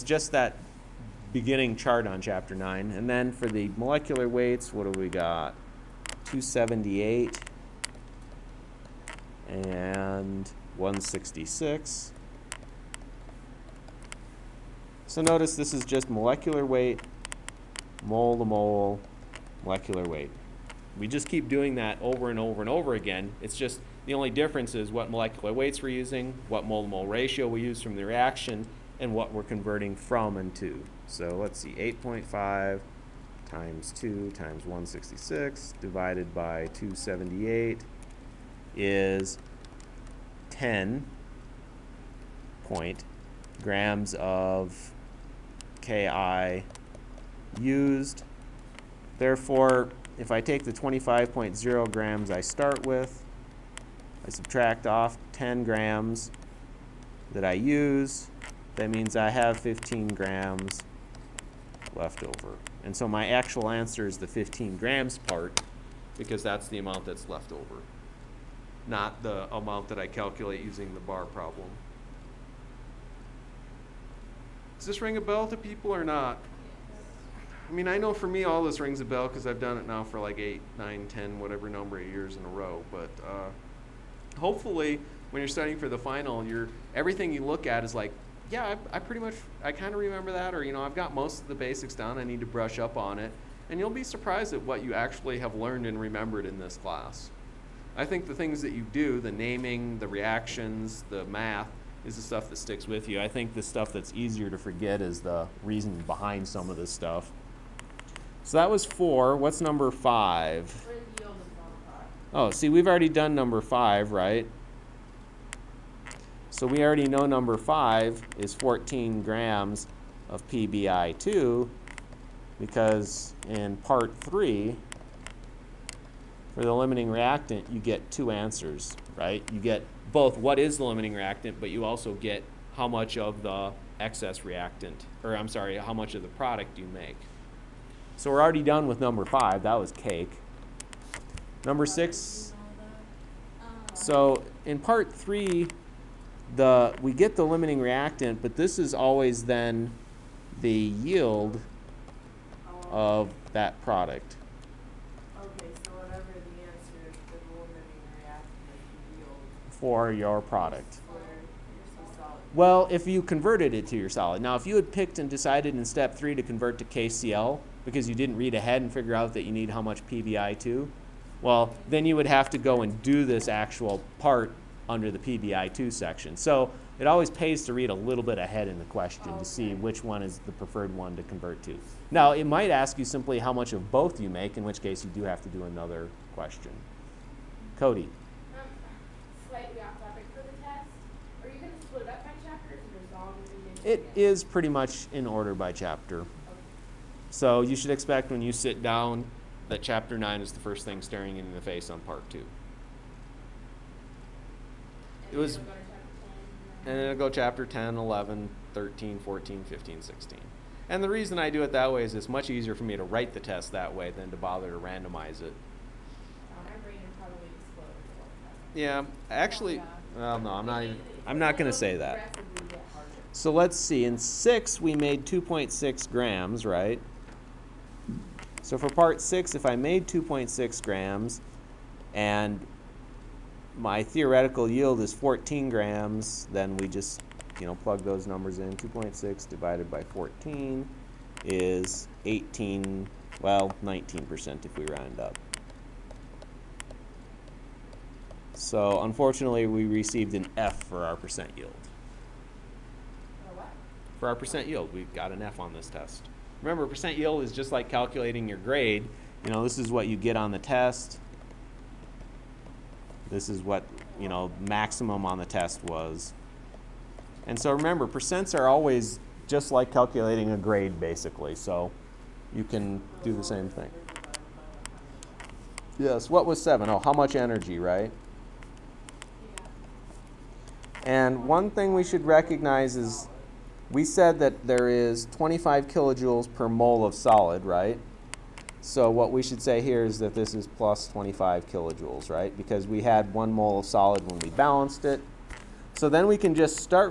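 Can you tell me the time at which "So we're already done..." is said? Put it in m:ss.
2:18.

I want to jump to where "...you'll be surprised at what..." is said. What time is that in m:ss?
1:33.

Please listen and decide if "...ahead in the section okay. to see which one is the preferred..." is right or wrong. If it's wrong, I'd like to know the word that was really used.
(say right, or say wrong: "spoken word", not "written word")
wrong: "question", not "section".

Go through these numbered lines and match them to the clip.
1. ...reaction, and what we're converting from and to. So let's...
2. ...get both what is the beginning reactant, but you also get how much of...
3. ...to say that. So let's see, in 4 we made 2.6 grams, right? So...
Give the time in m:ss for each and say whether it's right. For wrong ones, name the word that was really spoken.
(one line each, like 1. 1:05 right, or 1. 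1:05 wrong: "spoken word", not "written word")
1. 0:28 right
2. 2:09 wrong: "limiting", not "beginning"
3. 3:41 wrong: "6", not "4".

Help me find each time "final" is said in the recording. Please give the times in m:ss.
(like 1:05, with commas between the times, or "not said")
1:25.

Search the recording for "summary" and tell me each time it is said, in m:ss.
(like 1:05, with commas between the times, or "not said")
not said.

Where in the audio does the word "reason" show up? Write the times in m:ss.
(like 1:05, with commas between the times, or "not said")
1:45, 3:31.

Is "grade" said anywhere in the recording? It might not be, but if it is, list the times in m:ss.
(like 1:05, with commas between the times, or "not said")
4:18, 4:30.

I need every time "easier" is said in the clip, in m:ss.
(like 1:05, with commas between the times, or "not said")
1:44, 3:32.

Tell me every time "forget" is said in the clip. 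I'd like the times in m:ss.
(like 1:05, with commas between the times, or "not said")
1:44.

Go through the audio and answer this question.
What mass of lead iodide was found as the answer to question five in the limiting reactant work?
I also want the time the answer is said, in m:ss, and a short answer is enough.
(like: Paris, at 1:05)
14 grams, at 1:58.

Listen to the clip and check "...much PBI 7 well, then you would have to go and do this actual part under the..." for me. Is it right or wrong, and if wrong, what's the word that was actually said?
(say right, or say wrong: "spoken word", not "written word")
wrong: "2", not "7".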